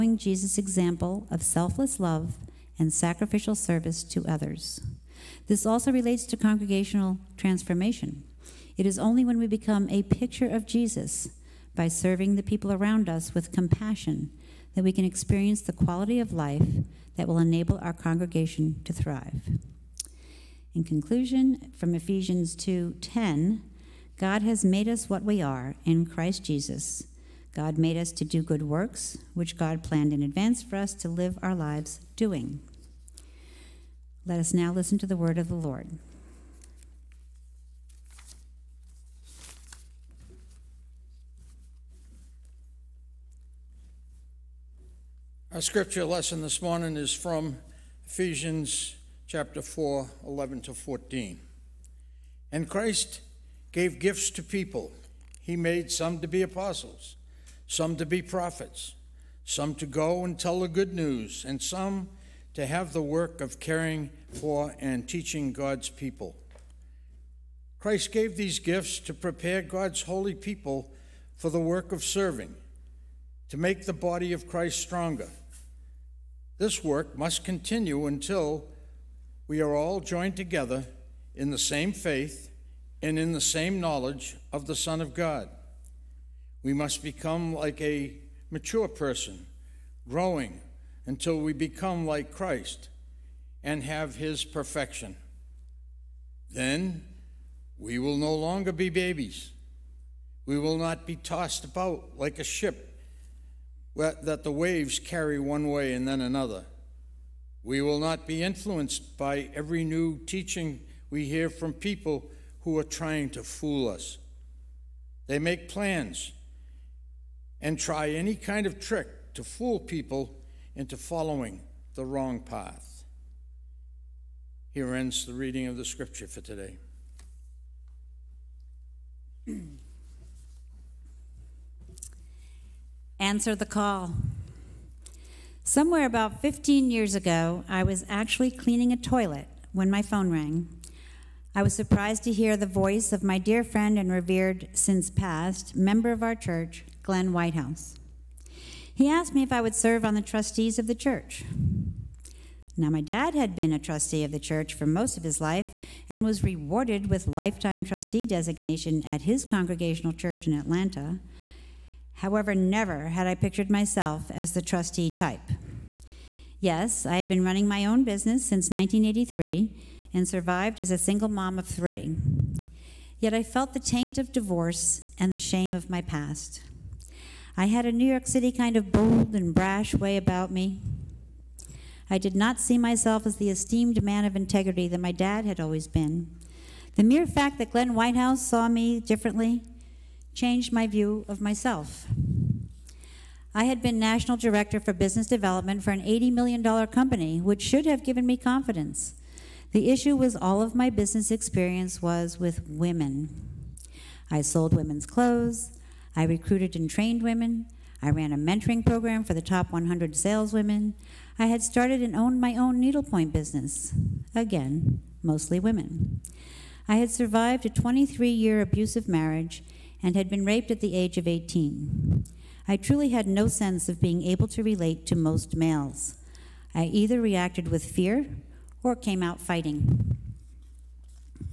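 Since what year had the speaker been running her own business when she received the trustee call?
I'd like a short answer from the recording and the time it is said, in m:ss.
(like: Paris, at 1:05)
1983, at 2:48.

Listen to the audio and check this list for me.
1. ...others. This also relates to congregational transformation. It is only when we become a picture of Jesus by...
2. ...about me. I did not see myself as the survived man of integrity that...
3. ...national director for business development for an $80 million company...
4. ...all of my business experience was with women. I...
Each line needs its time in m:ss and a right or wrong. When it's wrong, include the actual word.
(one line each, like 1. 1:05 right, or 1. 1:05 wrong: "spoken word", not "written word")
1. 0:04 right
2. 3:00 wrong: "esteemed", not "survived"
3. 3:13 right
4. 3:20 right.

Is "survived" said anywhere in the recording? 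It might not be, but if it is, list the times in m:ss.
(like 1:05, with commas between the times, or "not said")
2:50, 3:37.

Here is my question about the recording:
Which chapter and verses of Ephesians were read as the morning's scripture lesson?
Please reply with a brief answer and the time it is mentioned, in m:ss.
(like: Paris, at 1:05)
Ephesians 4:11-14, at 0:48.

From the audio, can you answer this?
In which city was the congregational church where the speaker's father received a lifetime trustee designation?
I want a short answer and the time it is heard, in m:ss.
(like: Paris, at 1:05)
Atlanta, at 2:40.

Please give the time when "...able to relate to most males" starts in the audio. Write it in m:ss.
3:44.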